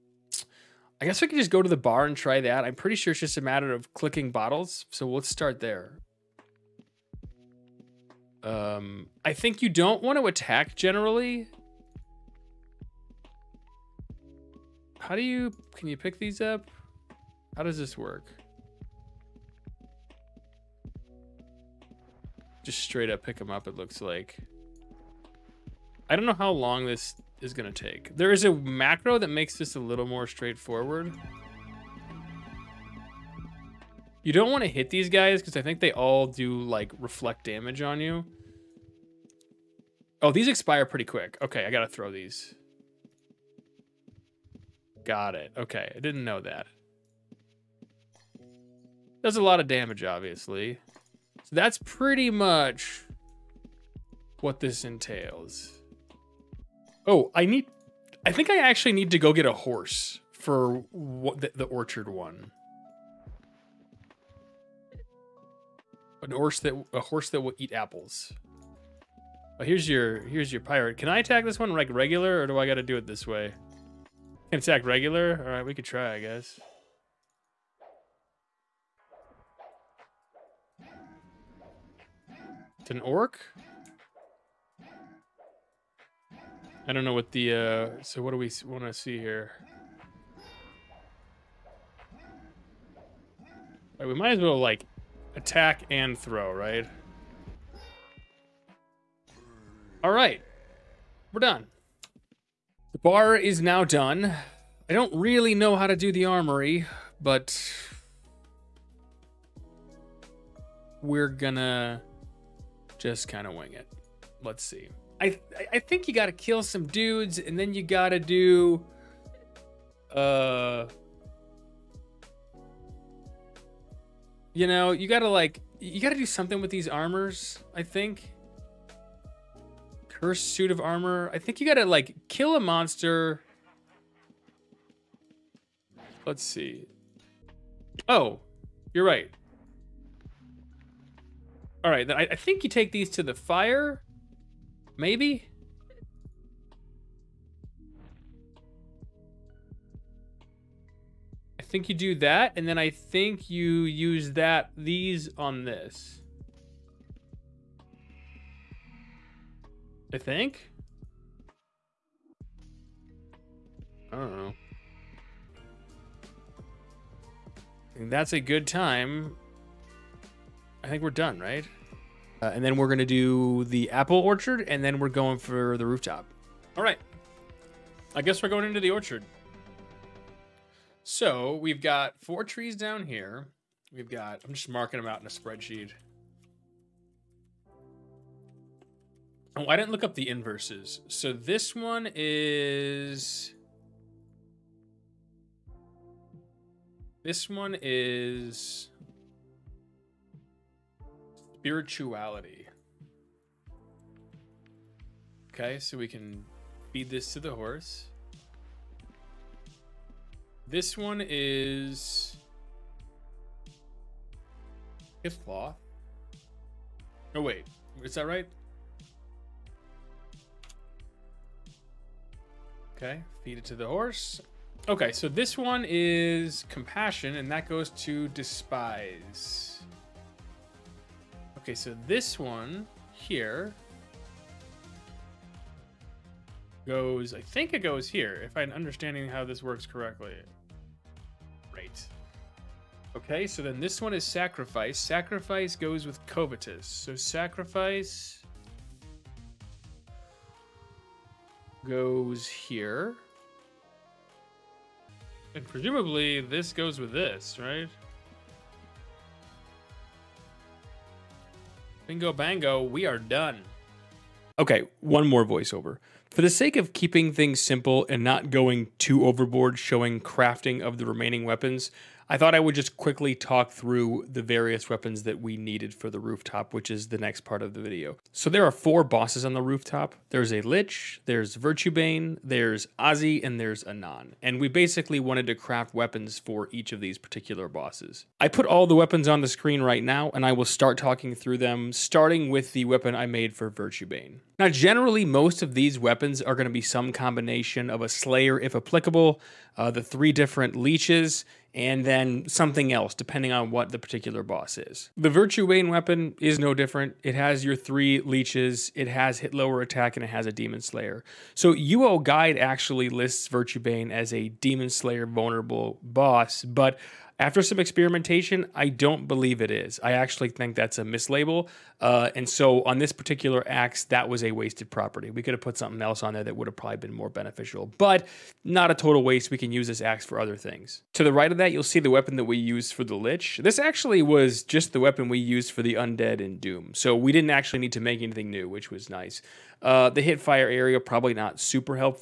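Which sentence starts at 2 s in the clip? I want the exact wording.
I'm pretty sure it's just a matter of clicking bottles.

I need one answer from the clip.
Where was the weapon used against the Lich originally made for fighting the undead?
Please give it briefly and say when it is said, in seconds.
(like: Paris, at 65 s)
Doom, at 336 s.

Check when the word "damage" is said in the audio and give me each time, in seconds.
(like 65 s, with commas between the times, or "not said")
37 s, 49 s.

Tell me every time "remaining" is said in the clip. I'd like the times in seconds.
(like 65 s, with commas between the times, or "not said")
271 s.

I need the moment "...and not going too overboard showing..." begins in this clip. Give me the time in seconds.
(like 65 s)
268 s.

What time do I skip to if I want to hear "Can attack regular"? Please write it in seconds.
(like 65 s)
74 s.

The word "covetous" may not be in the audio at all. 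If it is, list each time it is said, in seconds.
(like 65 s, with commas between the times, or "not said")
246 s.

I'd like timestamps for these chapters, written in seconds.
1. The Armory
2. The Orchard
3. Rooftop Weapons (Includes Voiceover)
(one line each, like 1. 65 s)
1. 100 s
2. 175 s
3. 263 s.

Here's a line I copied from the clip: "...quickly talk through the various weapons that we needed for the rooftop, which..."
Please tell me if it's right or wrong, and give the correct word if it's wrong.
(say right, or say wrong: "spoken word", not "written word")
right.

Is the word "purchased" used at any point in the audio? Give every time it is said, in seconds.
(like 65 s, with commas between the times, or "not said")
not said.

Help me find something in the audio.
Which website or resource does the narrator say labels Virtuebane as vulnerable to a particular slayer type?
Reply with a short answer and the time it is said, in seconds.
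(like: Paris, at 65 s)
UO Guide, at 311 s.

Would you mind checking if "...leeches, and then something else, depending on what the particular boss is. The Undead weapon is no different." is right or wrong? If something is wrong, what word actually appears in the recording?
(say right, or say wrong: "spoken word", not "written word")
wrong: "Virtuebane", not "Undead".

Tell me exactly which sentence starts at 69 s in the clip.
Oh, here's your here's your pirate.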